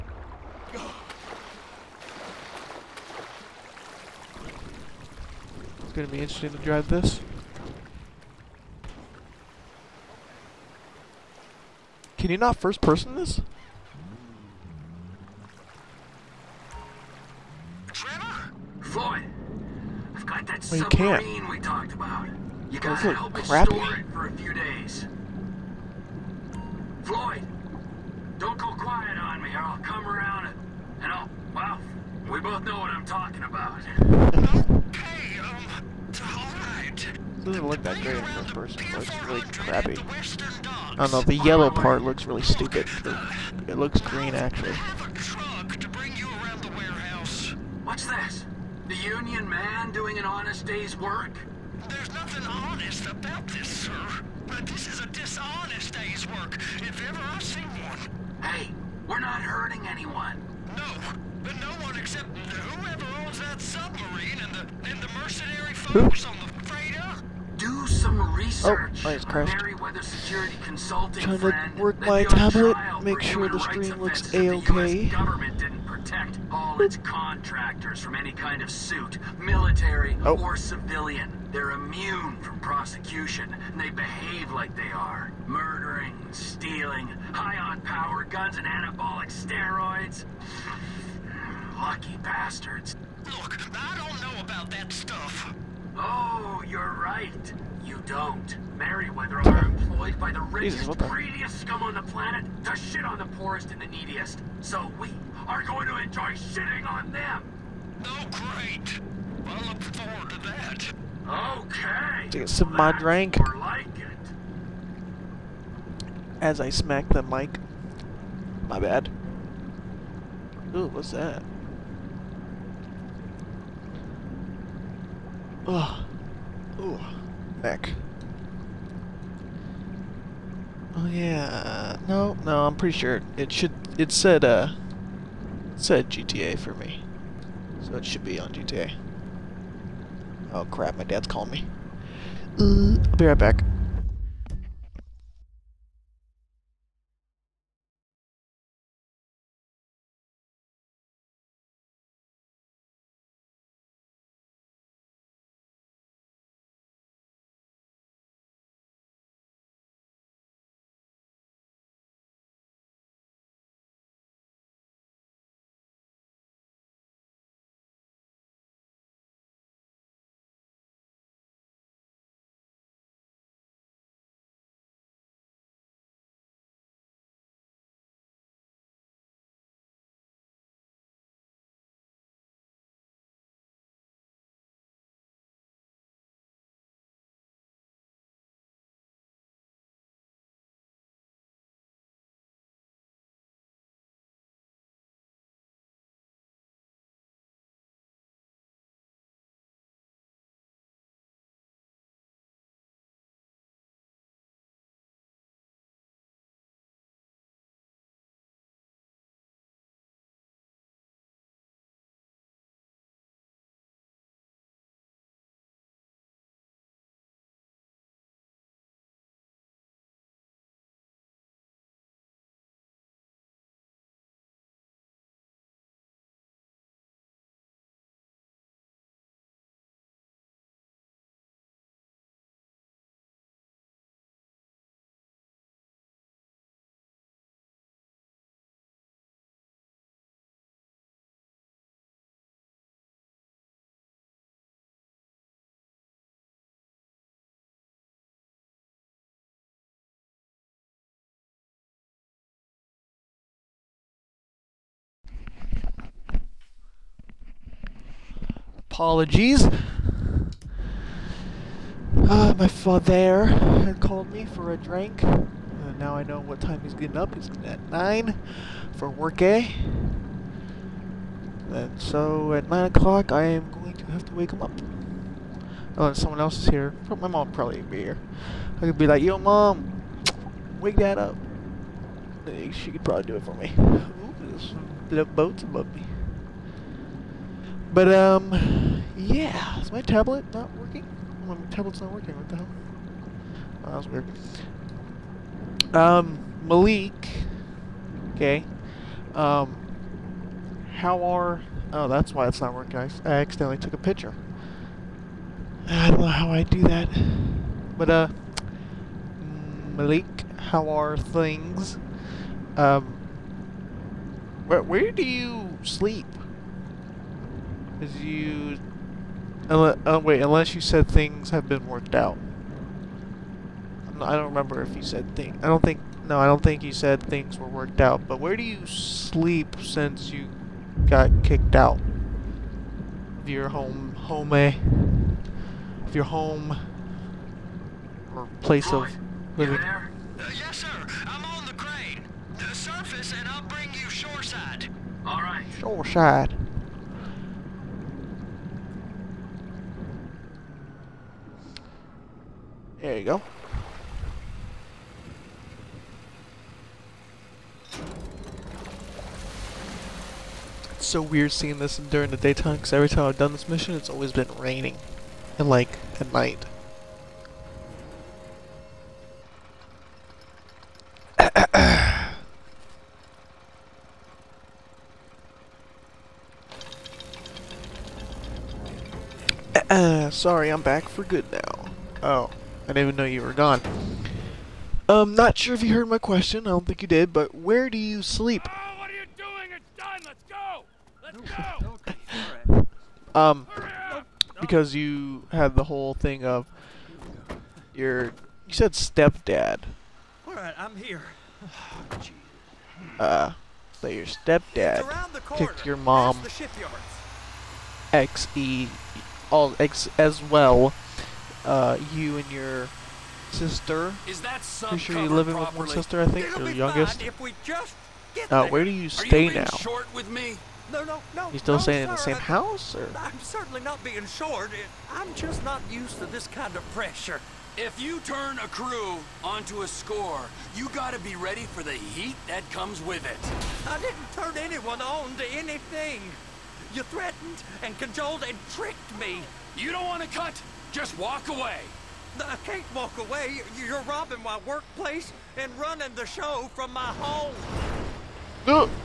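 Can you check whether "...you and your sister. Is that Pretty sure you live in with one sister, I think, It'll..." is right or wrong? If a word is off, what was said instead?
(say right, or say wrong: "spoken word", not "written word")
right.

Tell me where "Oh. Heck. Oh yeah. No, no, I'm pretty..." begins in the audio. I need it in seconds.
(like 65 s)
126 s.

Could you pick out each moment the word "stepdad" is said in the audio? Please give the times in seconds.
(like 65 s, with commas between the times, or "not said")
398 s, 404 s.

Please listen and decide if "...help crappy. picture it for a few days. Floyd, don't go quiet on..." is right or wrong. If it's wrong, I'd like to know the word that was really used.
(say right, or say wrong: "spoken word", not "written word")
wrong: "store", not "picture".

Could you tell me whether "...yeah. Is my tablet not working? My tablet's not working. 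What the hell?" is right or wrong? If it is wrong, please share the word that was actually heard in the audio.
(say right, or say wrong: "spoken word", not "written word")
right.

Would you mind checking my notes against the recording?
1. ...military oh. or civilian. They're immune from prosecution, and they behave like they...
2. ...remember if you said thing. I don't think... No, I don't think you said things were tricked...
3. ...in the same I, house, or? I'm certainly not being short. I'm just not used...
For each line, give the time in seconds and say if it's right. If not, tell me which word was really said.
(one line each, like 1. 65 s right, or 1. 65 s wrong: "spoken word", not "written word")
1. 79 s right
2. 324 s wrong: "worked", not "tricked"
3. 422 s right.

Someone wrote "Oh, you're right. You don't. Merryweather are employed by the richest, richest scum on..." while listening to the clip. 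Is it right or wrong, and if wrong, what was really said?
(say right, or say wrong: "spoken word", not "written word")
wrong: "greediest", not "richest".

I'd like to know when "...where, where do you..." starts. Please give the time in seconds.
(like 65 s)
314 s.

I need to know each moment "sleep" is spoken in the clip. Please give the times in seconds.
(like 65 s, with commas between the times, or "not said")
315 s, 328 s, 388 s.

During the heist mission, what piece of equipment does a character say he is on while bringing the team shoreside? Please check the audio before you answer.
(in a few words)
the crane.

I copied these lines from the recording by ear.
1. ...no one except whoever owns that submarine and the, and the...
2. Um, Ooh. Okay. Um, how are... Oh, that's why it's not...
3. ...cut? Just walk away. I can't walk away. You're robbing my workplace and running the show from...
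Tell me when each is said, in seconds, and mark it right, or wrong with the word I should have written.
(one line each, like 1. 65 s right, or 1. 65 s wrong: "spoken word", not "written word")
1. 61 s right
2. 295 s wrong: "Malik", not "Ooh"
3. 440 s right.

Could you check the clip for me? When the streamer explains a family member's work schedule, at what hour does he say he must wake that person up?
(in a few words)
9.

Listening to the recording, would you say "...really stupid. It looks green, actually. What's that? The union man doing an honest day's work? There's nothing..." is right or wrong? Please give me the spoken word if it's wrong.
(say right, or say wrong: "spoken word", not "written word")
right.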